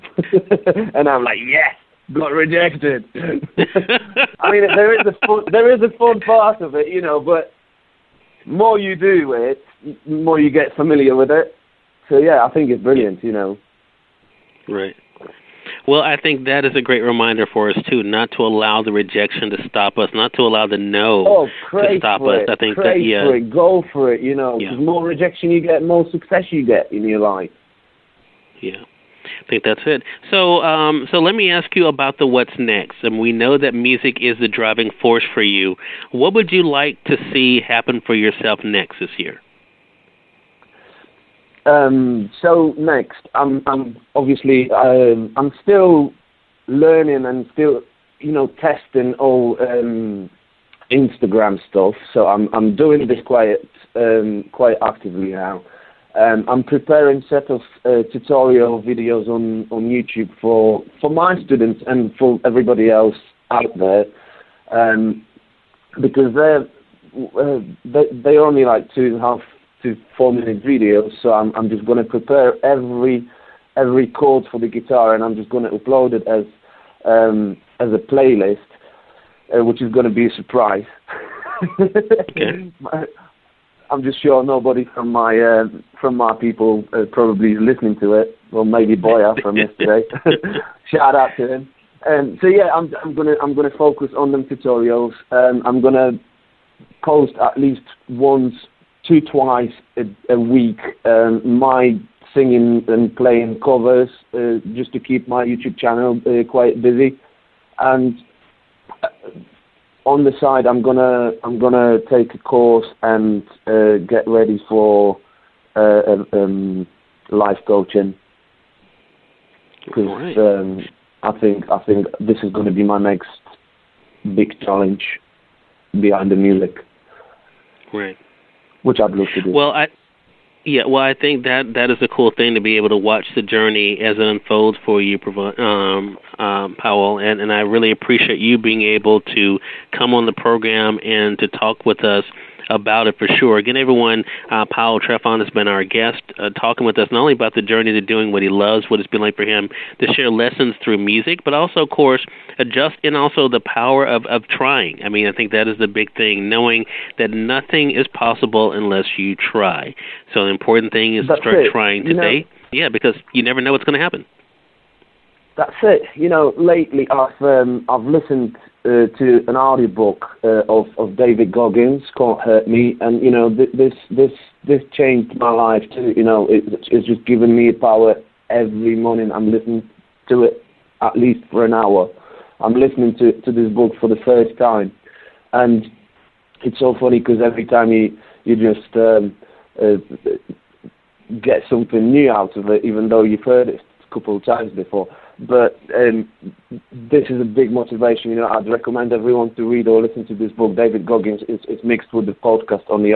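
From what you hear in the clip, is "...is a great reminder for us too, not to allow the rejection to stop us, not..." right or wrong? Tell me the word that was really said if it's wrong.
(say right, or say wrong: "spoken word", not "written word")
right.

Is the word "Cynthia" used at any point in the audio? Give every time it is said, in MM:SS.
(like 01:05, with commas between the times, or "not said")
not said.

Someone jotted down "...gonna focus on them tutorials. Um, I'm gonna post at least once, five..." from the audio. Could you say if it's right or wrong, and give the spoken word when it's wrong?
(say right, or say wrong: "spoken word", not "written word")
wrong: "two", not "five".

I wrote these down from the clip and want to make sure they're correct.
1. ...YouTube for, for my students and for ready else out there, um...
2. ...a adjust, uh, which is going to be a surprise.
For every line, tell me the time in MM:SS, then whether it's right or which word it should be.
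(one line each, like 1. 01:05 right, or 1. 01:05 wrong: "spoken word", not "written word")
1. 00:59 wrong: "everybody", not "ready"
2. 01:17 wrong: "playlist", not "adjust".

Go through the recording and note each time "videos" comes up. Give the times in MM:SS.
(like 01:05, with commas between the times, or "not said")
00:58, 01:10.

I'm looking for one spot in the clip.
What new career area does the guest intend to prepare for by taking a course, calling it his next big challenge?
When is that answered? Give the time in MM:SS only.
01:57.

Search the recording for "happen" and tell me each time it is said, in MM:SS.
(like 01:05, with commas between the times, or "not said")
00:37, 02:44.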